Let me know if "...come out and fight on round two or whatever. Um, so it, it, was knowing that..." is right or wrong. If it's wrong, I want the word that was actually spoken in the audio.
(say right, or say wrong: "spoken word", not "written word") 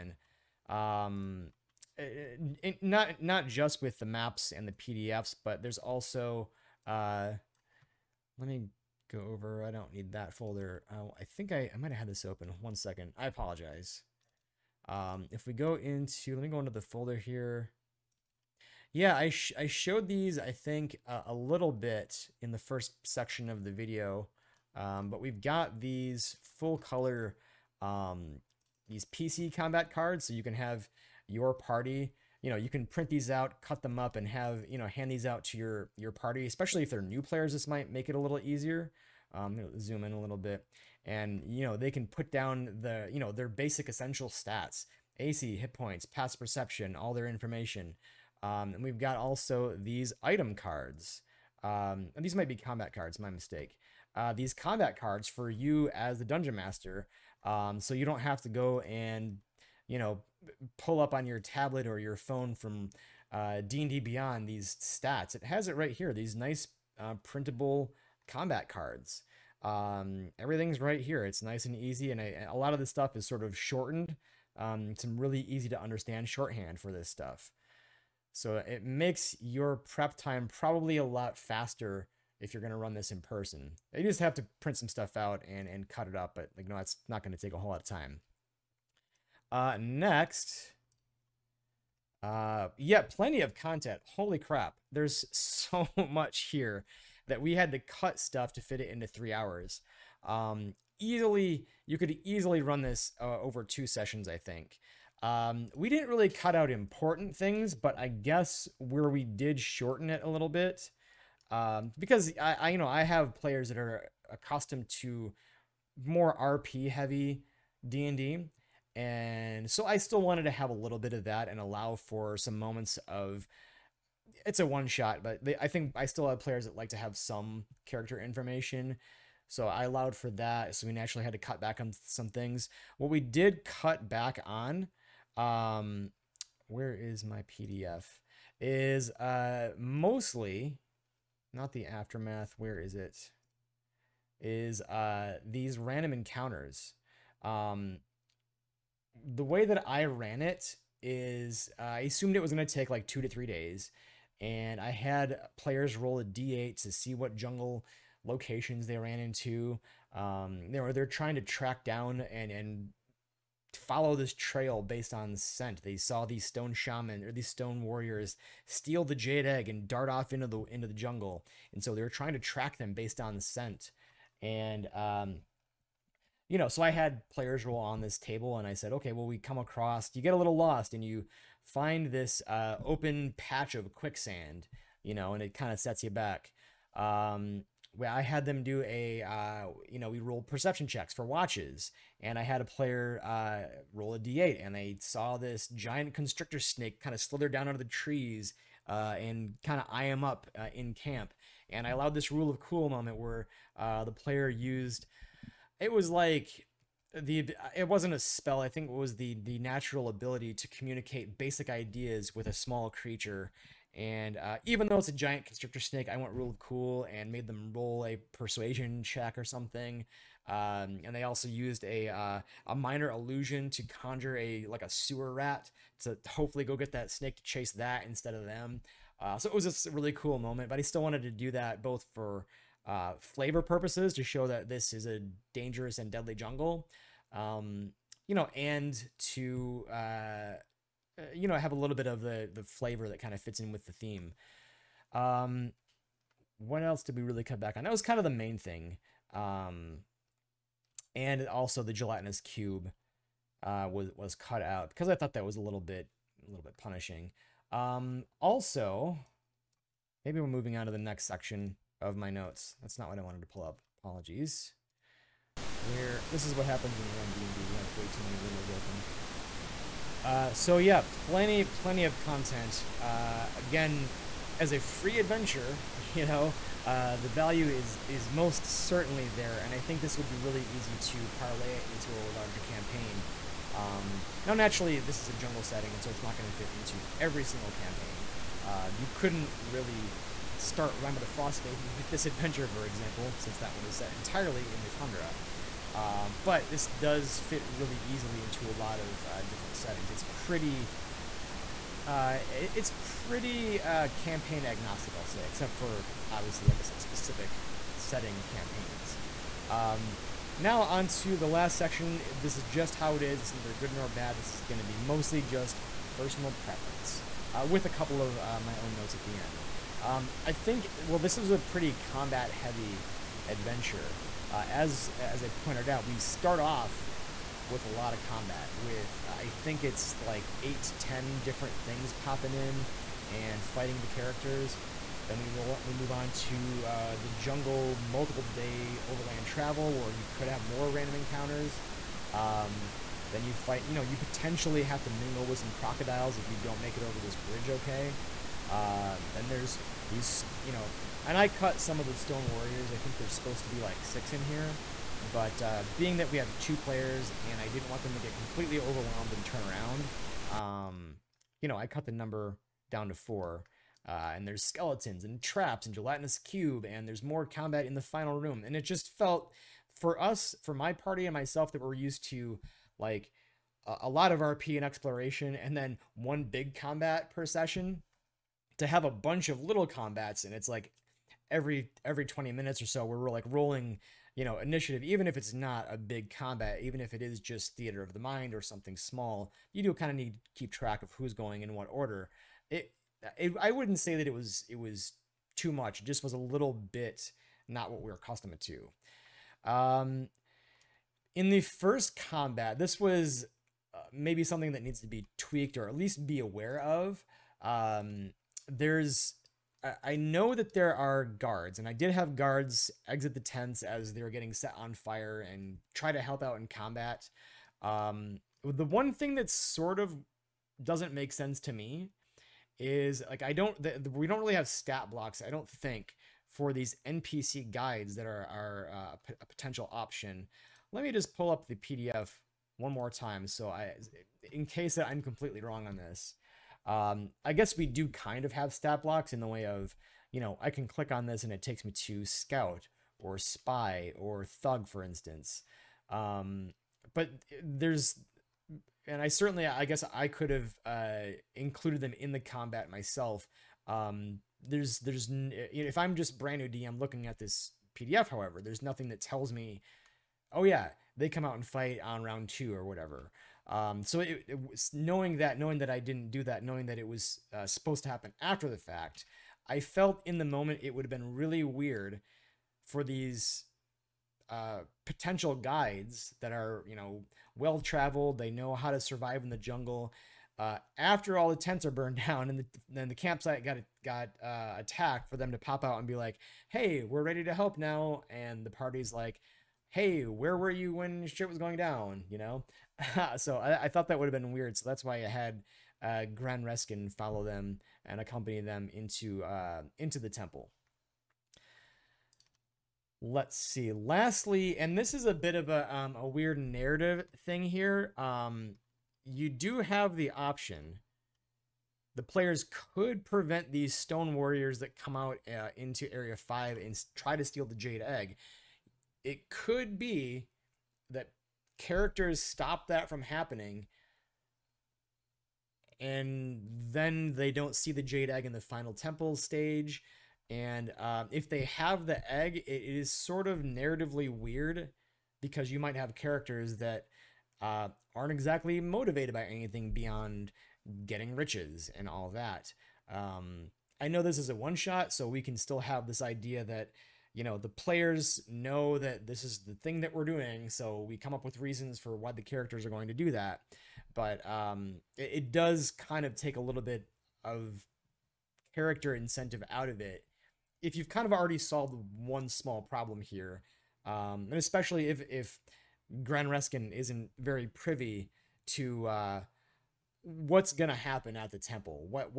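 right.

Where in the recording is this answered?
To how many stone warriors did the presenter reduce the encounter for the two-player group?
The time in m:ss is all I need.
6:03.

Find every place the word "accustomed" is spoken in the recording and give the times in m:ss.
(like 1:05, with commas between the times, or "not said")
1:54, 6:38.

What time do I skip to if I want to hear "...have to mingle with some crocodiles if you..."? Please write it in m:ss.
5:44.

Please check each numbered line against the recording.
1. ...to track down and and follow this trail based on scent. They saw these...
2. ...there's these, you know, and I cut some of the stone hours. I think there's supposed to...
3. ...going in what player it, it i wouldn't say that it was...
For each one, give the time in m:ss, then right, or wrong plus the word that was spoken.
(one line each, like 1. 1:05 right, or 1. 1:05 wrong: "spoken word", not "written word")
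1. 2:41 right
2. 5:49 wrong: "warriors", not "hours"
3. 6:31 wrong: "order", not "player".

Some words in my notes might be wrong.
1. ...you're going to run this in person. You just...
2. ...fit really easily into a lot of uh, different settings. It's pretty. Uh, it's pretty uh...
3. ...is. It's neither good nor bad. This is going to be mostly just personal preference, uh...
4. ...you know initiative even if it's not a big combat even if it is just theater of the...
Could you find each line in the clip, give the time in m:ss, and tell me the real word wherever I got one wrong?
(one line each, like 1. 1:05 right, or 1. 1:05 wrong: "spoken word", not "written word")
1. 1:22 right
2. 4:57 right
3. 5:13 right
4. 6:24 right.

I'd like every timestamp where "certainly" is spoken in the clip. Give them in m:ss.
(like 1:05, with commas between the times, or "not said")
4:38, 7:29.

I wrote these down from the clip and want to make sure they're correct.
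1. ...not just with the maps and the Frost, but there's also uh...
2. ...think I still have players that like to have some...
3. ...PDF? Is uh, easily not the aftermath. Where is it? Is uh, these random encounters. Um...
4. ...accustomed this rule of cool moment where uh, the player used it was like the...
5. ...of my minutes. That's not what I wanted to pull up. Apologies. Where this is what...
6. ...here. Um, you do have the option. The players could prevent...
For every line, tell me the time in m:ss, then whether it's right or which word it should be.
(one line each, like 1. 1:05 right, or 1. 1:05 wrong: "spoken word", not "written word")
1. 0:03 wrong: "PDFs", not "Frost"
2. 2:05 right
3. 2:17 wrong: "mostly", not "easily"
4. 3:21 wrong: "allowed", not "accustomed"
5. 4:22 wrong: "notes", not "minutes"
6. 8:27 right.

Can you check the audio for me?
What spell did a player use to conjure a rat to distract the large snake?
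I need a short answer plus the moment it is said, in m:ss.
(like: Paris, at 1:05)
minor illusion, at 3:42.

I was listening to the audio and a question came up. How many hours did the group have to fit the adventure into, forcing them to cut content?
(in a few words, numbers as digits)
3.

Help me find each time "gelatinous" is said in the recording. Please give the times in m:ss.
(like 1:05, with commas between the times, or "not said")
4:11, 6:05.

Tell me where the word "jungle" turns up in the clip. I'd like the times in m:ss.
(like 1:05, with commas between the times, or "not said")
2:37, 2:50, 3:56, 4:45, 5:37, 7:59.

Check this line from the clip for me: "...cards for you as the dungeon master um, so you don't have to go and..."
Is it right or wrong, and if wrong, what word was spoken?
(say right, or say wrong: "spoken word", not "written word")
right.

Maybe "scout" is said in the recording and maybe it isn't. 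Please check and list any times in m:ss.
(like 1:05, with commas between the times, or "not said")
7:22.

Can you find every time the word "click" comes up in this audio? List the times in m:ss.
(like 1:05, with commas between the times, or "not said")
7:20.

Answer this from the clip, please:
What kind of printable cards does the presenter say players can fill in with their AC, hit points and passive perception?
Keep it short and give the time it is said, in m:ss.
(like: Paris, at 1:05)
PC combat cards, at 0:29.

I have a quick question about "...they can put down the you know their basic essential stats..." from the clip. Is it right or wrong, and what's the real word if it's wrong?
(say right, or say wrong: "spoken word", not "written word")
right.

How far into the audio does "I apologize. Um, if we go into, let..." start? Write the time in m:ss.
0:13.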